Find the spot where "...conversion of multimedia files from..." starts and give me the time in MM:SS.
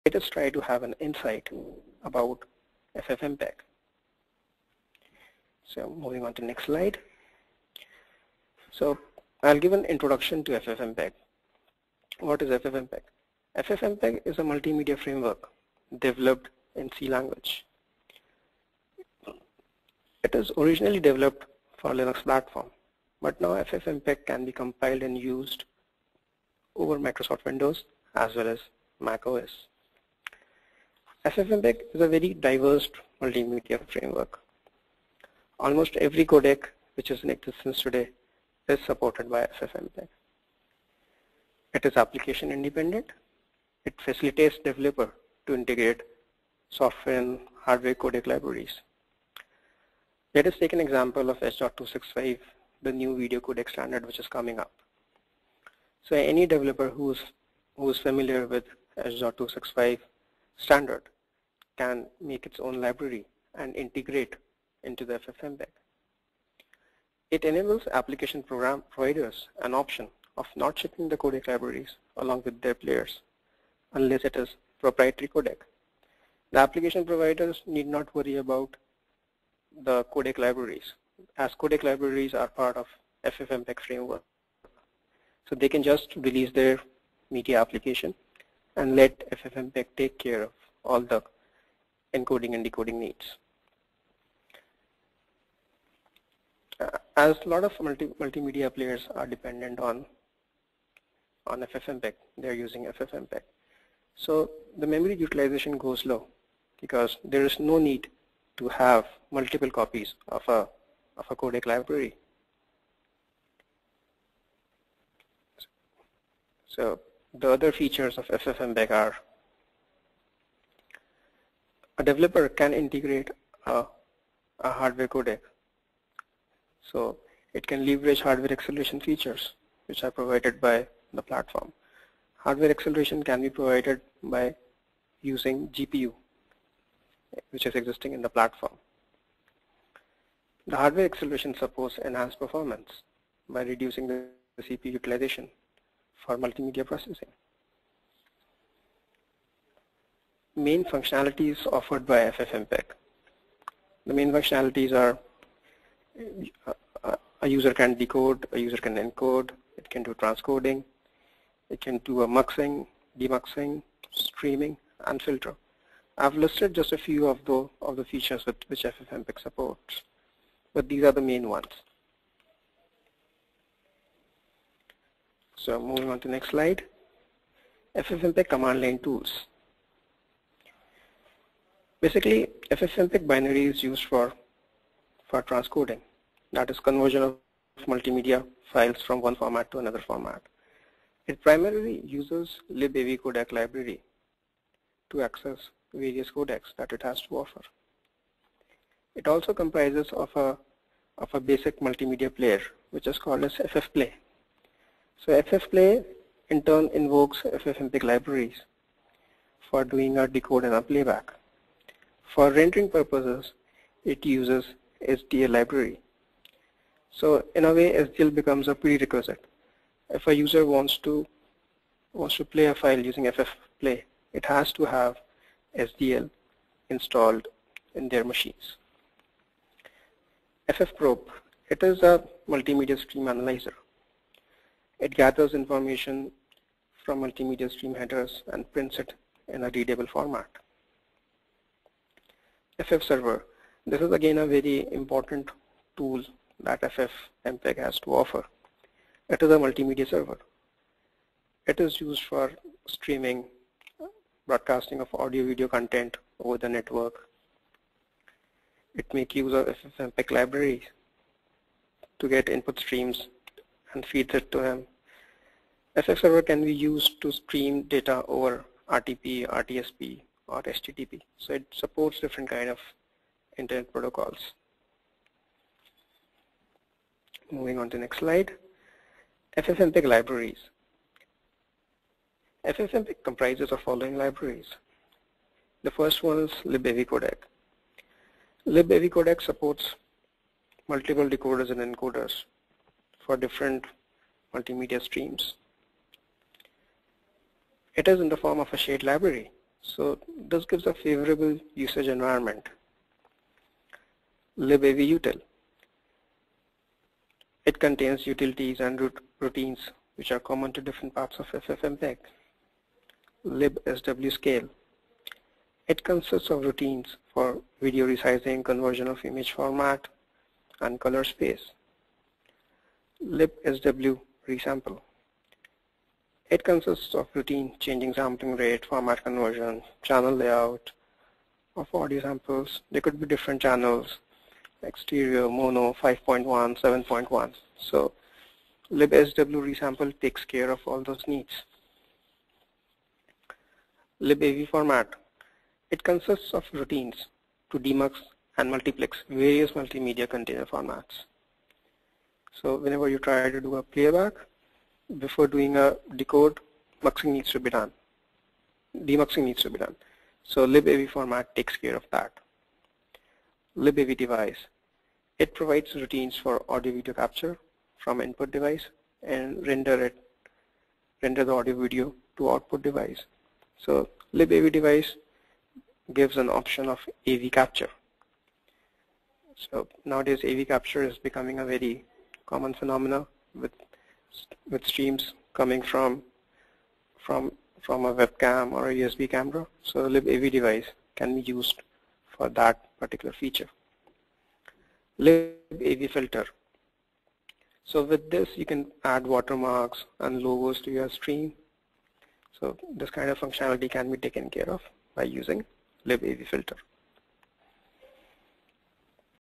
03:06.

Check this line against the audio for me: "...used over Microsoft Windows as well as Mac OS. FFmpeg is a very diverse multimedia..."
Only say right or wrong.
right.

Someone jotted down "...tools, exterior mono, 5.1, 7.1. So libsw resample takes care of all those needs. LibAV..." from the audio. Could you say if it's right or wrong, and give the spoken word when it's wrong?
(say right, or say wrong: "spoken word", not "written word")
wrong: "channels", not "tools".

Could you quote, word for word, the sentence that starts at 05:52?
So whenever you try to do a playback, before doing a decode, muxing needs to be done.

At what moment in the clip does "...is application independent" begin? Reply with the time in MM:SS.
00:41.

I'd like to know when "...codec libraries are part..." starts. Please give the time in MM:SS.
01:21.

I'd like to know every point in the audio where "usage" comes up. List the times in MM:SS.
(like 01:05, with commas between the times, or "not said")
05:01.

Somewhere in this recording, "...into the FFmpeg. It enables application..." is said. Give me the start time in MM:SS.
01:04.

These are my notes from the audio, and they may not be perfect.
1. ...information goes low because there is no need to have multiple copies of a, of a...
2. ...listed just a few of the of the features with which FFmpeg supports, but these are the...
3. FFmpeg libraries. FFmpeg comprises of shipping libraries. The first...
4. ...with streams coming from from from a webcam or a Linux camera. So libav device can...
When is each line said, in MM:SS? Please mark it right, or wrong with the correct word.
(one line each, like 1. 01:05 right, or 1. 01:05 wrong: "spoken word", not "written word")
1. 01:45 wrong: "utilization", not "information"
2. 02:46 right
3. 04:39 wrong: "following", not "shipping"
4. 06:24 wrong: "USB", not "Linux".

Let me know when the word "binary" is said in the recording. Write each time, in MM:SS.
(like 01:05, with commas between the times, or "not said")
03:03.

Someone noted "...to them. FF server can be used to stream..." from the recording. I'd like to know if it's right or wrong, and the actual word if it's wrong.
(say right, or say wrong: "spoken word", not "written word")
right.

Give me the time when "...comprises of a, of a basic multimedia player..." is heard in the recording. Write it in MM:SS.
03:19.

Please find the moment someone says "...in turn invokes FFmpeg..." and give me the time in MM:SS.
03:26.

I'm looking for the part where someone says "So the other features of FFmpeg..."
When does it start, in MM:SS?
01:56.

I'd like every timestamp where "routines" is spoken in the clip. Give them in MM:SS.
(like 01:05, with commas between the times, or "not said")
05:09, 05:16, 05:27, 05:46, 06:05.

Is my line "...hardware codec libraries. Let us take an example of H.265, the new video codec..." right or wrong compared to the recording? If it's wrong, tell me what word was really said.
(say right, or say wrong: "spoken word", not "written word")
right.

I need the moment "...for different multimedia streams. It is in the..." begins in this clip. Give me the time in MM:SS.
04:53.